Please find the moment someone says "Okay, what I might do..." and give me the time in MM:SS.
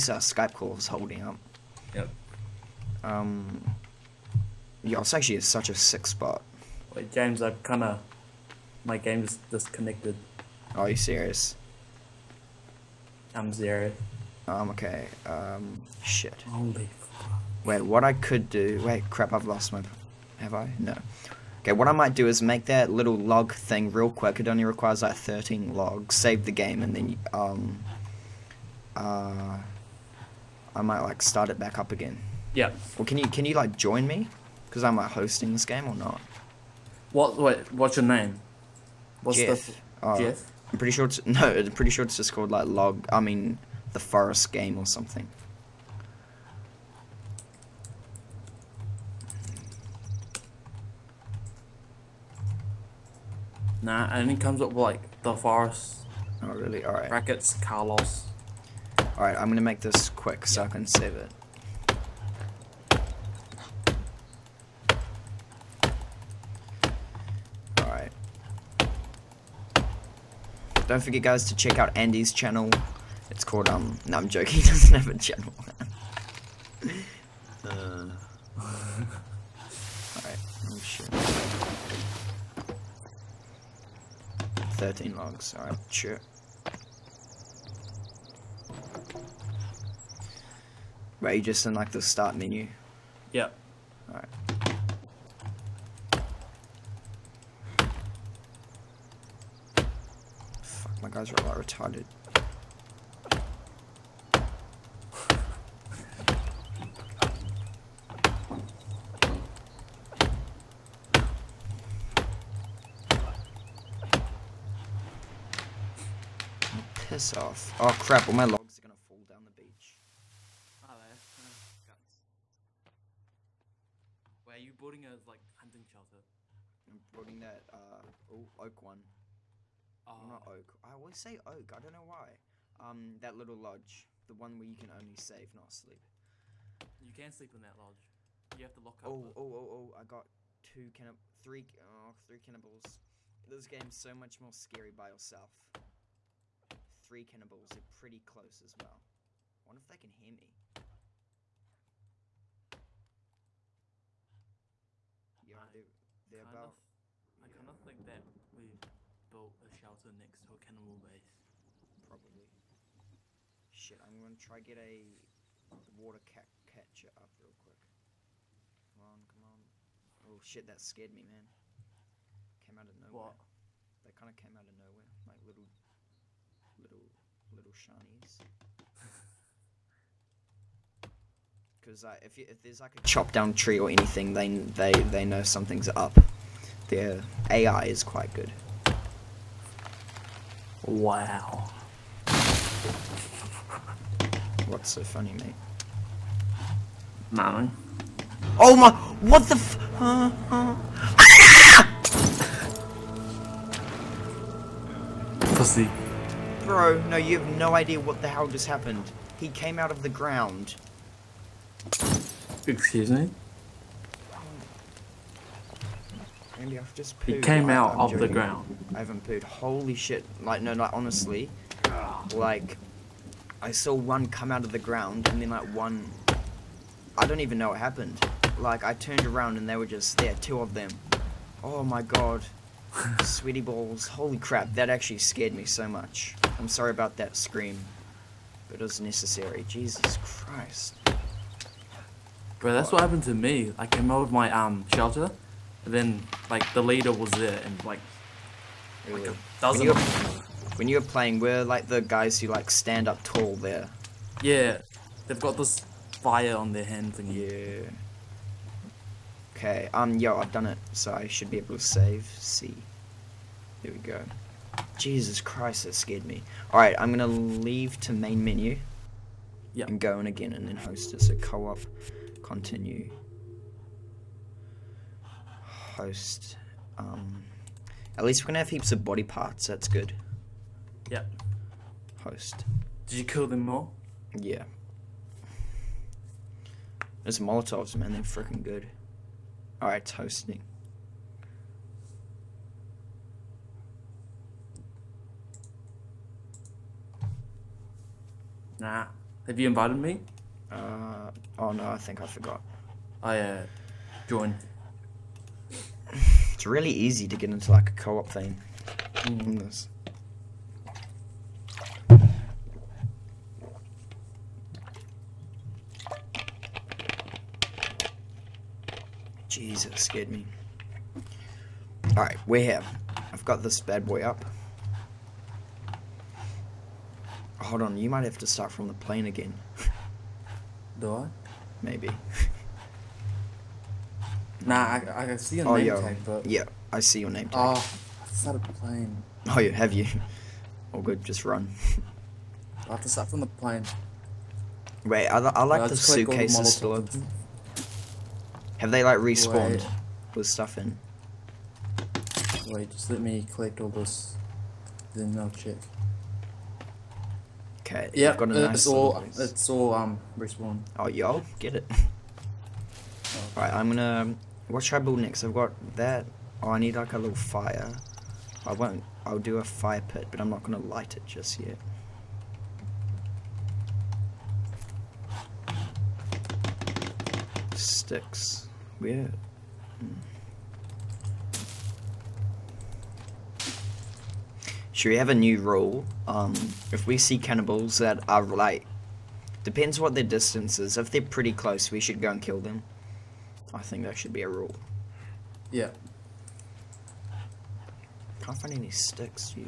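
00:21.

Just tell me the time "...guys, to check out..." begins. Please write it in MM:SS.
01:11.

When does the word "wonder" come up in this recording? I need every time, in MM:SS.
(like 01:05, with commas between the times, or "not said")
02:29.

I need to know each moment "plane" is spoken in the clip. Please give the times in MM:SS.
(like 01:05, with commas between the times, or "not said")
05:28, 05:38, 05:43.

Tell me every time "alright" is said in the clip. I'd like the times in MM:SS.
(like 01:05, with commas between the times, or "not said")
01:18, 01:25, 04:26, 05:22, 06:03.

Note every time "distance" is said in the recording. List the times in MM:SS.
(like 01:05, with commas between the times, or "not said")
06:30.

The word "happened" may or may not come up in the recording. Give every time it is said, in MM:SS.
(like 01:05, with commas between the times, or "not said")
03:28, 03:47, 04:03.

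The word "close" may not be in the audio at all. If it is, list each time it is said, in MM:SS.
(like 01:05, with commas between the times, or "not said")
02:28, 06:31.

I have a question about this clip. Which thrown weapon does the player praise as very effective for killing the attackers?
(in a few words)
Molotovs.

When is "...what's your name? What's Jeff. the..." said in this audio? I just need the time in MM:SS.
00:37.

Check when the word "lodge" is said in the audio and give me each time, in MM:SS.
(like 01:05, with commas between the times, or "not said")
02:13, 02:17.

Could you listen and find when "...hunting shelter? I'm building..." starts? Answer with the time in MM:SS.
02:05.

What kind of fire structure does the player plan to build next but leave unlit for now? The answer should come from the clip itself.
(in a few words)
fire pit.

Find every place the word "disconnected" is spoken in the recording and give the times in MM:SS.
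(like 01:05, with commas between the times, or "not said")
00:09.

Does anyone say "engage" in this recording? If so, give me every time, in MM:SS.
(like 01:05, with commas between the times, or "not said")
not said.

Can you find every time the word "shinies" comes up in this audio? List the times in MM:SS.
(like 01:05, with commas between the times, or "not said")
02:57.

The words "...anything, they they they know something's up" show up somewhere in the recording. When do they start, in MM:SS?
03:03.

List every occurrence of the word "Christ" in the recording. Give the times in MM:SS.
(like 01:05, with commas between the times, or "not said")
04:00, 04:25.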